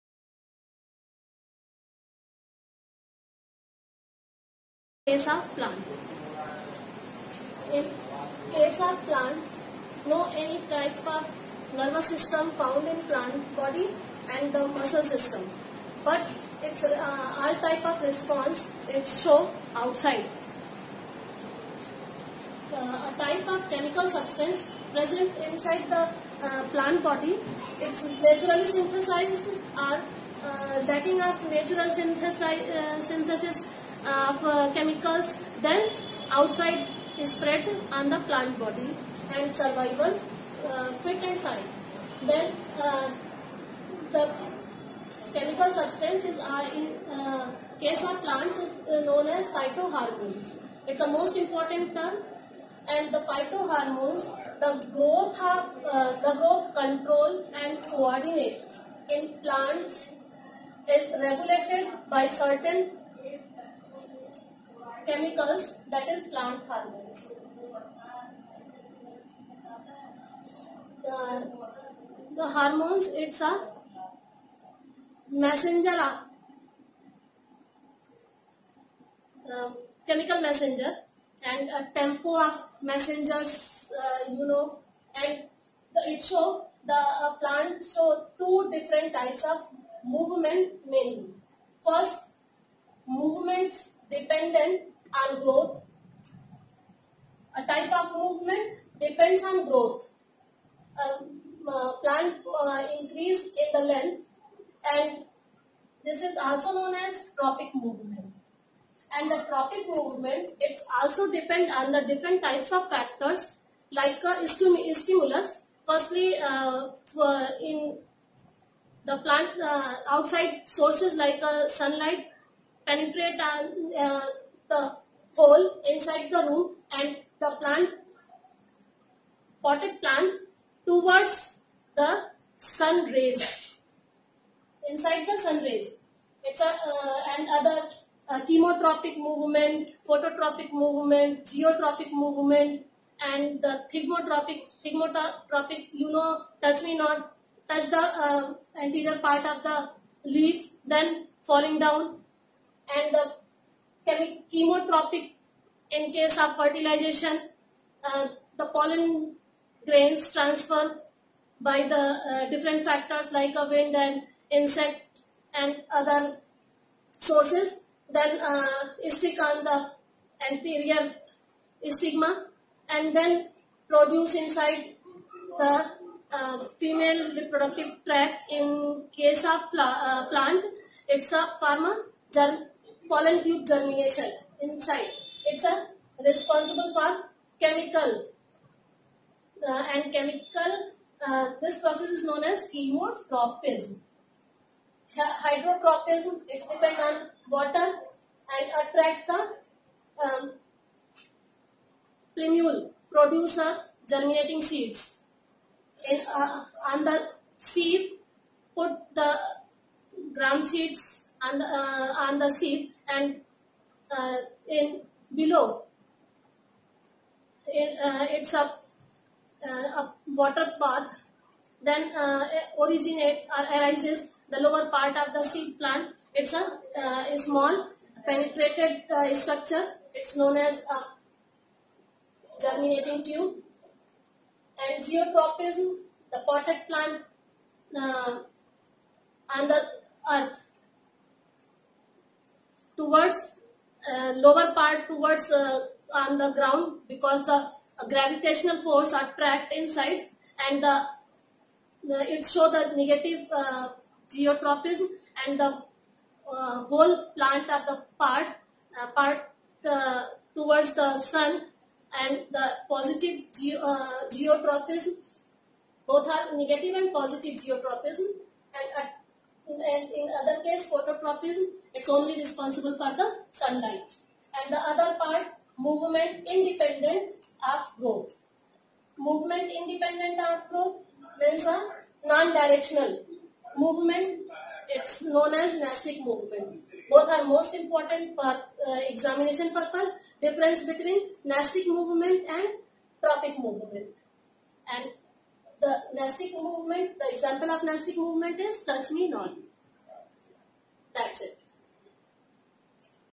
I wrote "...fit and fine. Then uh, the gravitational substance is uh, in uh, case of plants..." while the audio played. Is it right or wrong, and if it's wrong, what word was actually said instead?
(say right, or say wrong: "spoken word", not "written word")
wrong: "chemical", not "gravitational".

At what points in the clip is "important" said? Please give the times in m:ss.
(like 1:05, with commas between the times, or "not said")
0:51, 4:47.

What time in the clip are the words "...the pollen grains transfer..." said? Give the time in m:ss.
2:38.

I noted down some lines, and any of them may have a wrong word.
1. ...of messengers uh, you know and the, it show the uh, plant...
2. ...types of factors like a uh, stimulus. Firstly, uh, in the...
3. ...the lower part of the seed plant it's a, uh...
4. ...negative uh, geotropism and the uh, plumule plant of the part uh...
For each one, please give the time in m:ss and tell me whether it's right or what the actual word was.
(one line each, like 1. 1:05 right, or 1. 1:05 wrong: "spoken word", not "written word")
1. 1:22 right
2. 1:52 right
3. 3:44 right
4. 4:12 wrong: "whole", not "plumule".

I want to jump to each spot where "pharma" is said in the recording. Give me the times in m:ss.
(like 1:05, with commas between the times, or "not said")
3:01.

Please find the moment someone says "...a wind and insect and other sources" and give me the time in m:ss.
2:43.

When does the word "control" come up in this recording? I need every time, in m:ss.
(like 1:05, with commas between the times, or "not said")
0:56.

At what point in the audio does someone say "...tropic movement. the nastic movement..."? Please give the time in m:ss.
4:53.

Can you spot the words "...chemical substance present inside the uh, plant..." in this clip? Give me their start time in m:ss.
0:23.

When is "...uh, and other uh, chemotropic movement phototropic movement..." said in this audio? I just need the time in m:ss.
2:16.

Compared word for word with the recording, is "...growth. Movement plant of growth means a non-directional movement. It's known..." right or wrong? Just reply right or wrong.
wrong.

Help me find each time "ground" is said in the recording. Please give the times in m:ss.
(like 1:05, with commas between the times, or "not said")
3:30, 4:06.